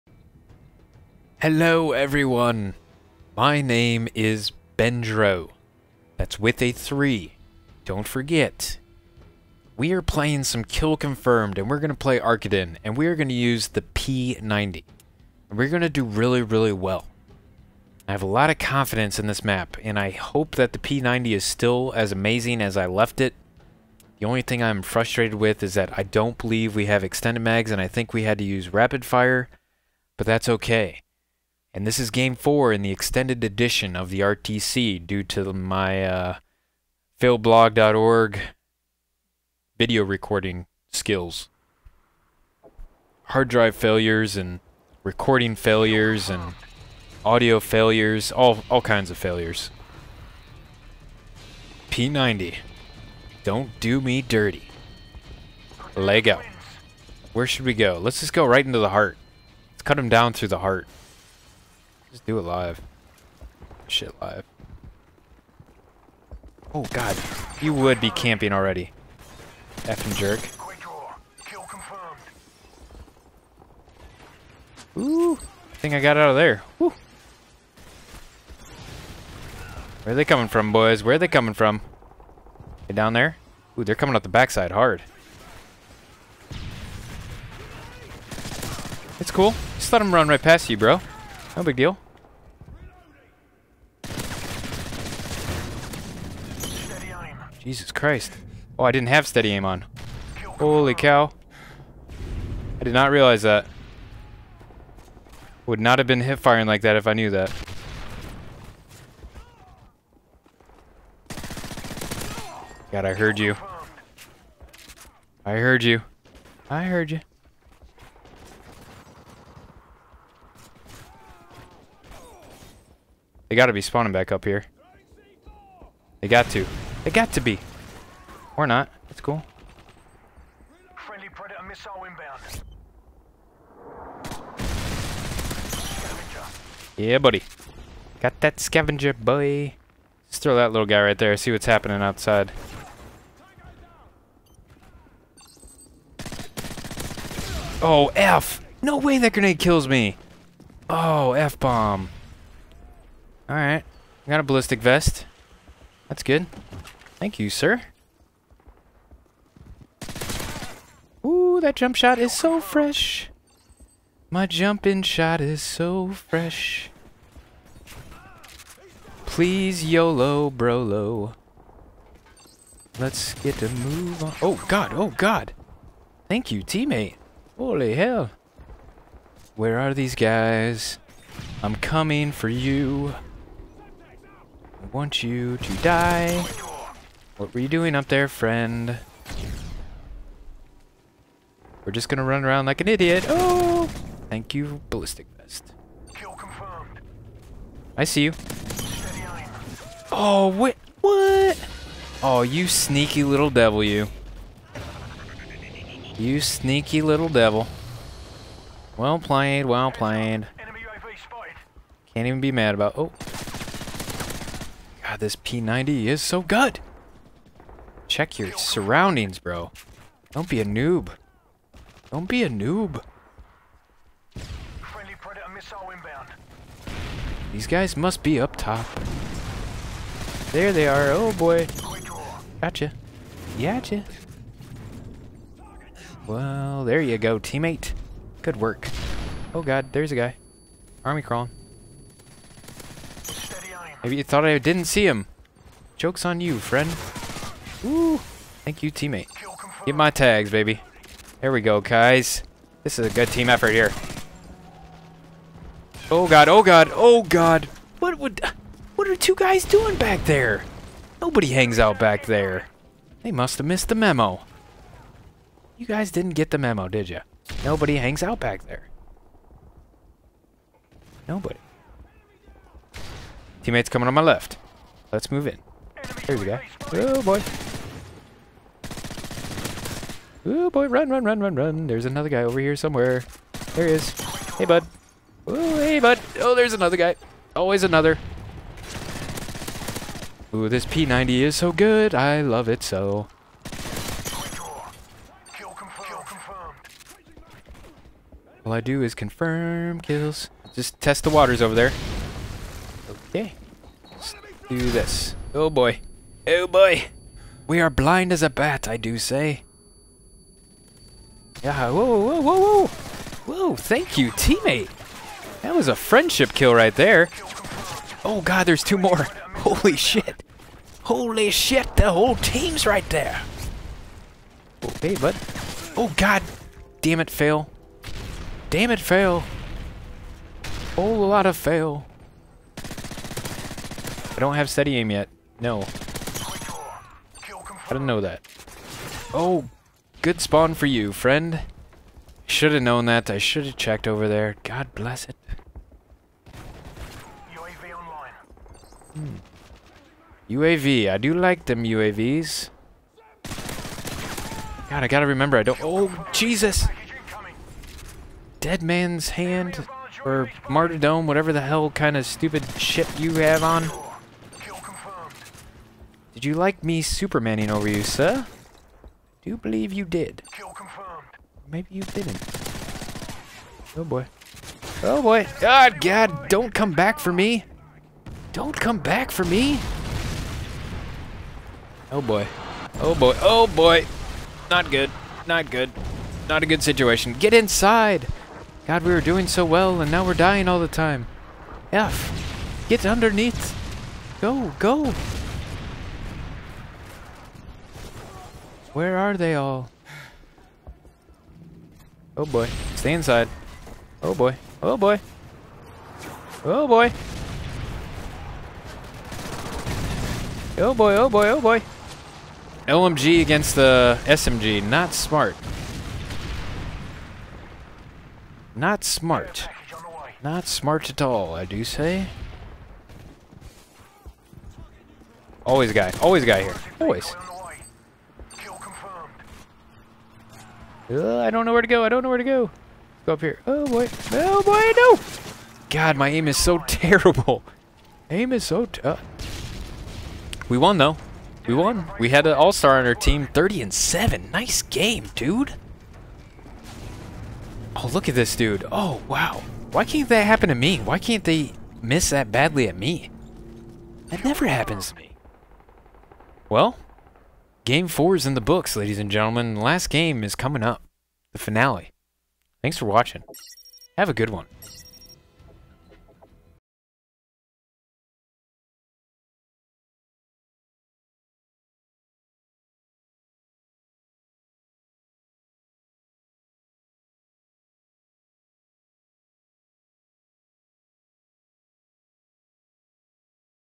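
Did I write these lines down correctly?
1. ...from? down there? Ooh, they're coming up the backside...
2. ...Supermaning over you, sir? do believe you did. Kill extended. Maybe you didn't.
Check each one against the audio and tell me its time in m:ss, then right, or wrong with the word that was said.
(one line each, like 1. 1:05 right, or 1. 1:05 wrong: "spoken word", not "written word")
1. 1:21 right
2. 6:07 wrong: "confirmed", not "extended".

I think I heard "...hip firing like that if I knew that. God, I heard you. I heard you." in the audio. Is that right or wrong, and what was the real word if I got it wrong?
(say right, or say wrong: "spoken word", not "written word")
right.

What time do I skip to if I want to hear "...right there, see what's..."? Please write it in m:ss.
2:21.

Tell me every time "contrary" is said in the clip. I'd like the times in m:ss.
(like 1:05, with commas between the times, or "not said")
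not said.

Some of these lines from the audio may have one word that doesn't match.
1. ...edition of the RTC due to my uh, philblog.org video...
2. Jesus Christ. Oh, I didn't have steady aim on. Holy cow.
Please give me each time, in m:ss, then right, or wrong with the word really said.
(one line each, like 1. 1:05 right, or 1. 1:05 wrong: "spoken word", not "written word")
1. 0:33 right
2. 1:37 right.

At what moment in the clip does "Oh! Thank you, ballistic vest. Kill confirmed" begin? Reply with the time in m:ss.
3:13.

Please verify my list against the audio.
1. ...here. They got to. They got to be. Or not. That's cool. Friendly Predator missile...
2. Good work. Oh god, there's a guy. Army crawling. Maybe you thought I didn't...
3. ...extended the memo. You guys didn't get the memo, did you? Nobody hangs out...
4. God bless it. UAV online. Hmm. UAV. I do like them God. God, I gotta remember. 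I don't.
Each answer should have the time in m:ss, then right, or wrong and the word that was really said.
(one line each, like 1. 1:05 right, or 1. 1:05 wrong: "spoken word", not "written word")
1. 2:04 right
2. 3:58 right
3. 4:23 wrong: "missed", not "extended"
4. 5:44 wrong: "UAVs", not "God".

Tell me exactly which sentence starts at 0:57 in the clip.
Let's just go right into the heart.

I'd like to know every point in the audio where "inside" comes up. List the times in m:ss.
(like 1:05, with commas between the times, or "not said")
6:27, 6:43.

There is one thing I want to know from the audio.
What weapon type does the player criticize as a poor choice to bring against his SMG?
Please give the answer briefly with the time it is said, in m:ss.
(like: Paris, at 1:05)
LMG, at 6:52.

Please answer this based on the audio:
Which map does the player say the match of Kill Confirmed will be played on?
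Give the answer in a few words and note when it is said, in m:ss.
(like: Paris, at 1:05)
Arkaden, at 0:12.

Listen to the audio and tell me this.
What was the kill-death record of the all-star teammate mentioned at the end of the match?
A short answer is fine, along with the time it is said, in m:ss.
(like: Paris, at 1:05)
30 and 7, at 7:23.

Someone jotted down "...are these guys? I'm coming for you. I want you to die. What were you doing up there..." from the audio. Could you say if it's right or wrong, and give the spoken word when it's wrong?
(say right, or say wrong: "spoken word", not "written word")
right.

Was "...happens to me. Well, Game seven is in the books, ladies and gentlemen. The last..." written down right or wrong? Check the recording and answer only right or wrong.
wrong.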